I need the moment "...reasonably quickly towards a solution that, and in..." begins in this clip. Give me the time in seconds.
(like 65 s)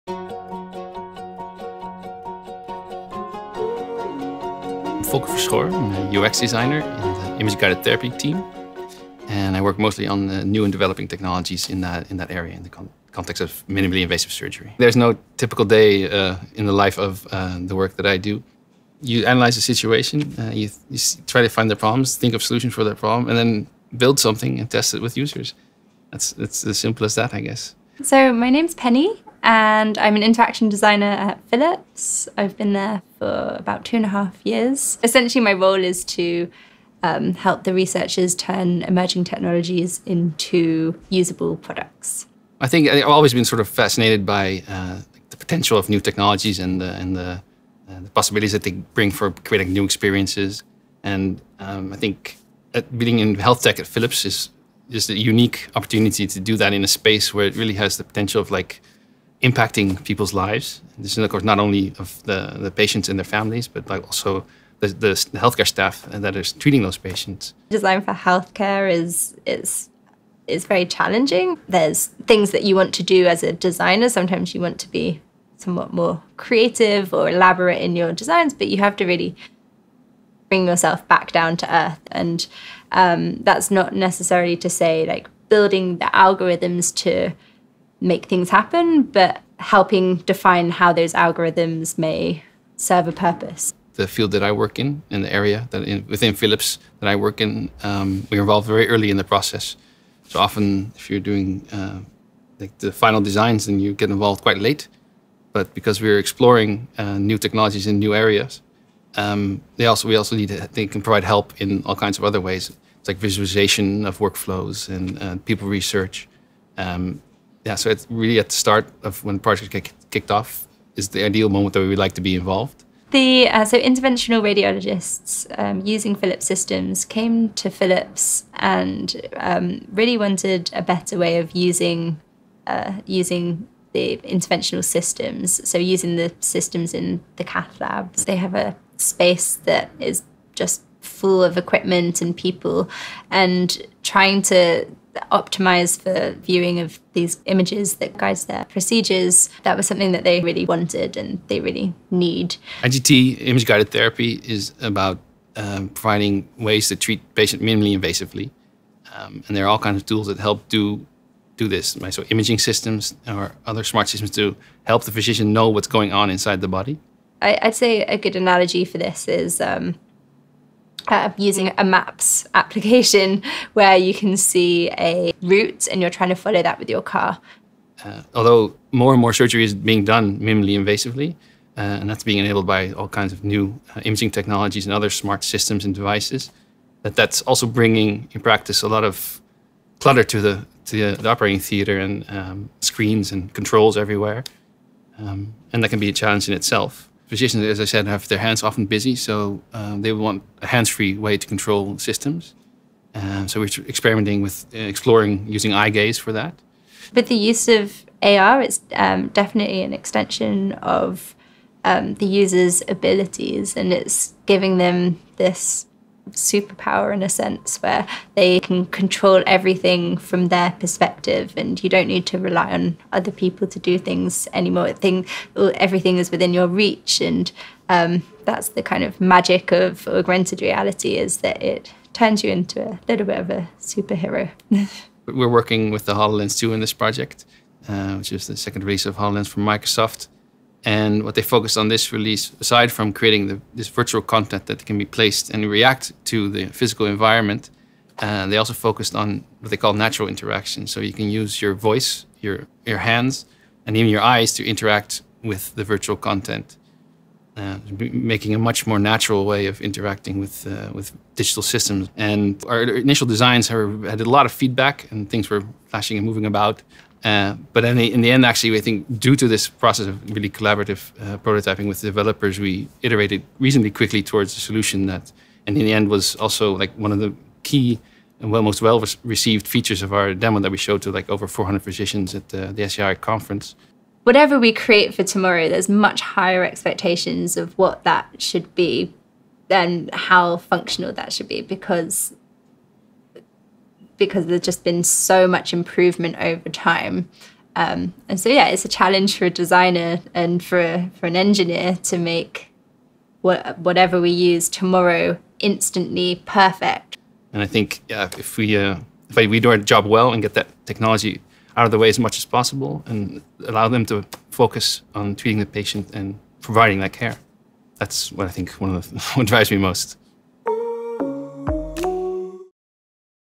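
273 s.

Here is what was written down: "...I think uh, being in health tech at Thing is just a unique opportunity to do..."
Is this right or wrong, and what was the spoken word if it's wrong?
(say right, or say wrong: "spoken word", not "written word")
wrong: "Philips", not "Thing".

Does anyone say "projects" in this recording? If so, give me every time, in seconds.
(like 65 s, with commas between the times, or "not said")
119 s, 236 s.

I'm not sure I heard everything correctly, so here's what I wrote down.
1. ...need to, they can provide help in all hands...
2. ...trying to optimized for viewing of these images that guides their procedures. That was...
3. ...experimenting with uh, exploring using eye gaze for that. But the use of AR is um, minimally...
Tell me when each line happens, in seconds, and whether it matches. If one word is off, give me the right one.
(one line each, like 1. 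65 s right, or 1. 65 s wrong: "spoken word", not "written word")
1. 110 s wrong: "kinds", not "hands"
2. 144 s right
3. 203 s wrong: "definitely", not "minimally".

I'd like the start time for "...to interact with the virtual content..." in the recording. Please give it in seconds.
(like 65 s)
254 s.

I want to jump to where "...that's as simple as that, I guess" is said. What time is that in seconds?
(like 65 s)
26 s.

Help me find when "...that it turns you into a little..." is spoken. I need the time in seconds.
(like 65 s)
231 s.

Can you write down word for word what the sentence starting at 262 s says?
And our initial designs had a lot of feedback, and things were flashing and moving about.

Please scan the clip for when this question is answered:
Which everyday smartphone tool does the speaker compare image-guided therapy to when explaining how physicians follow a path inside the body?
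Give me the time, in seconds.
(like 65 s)
171 s.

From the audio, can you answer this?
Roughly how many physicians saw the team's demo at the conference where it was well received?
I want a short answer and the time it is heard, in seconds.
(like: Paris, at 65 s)
400, at 281 s.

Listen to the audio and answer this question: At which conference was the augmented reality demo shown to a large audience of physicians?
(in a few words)
SCI conference.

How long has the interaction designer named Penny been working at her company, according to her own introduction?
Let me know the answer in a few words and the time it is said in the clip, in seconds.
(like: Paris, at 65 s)
2.5 years, at 33 s.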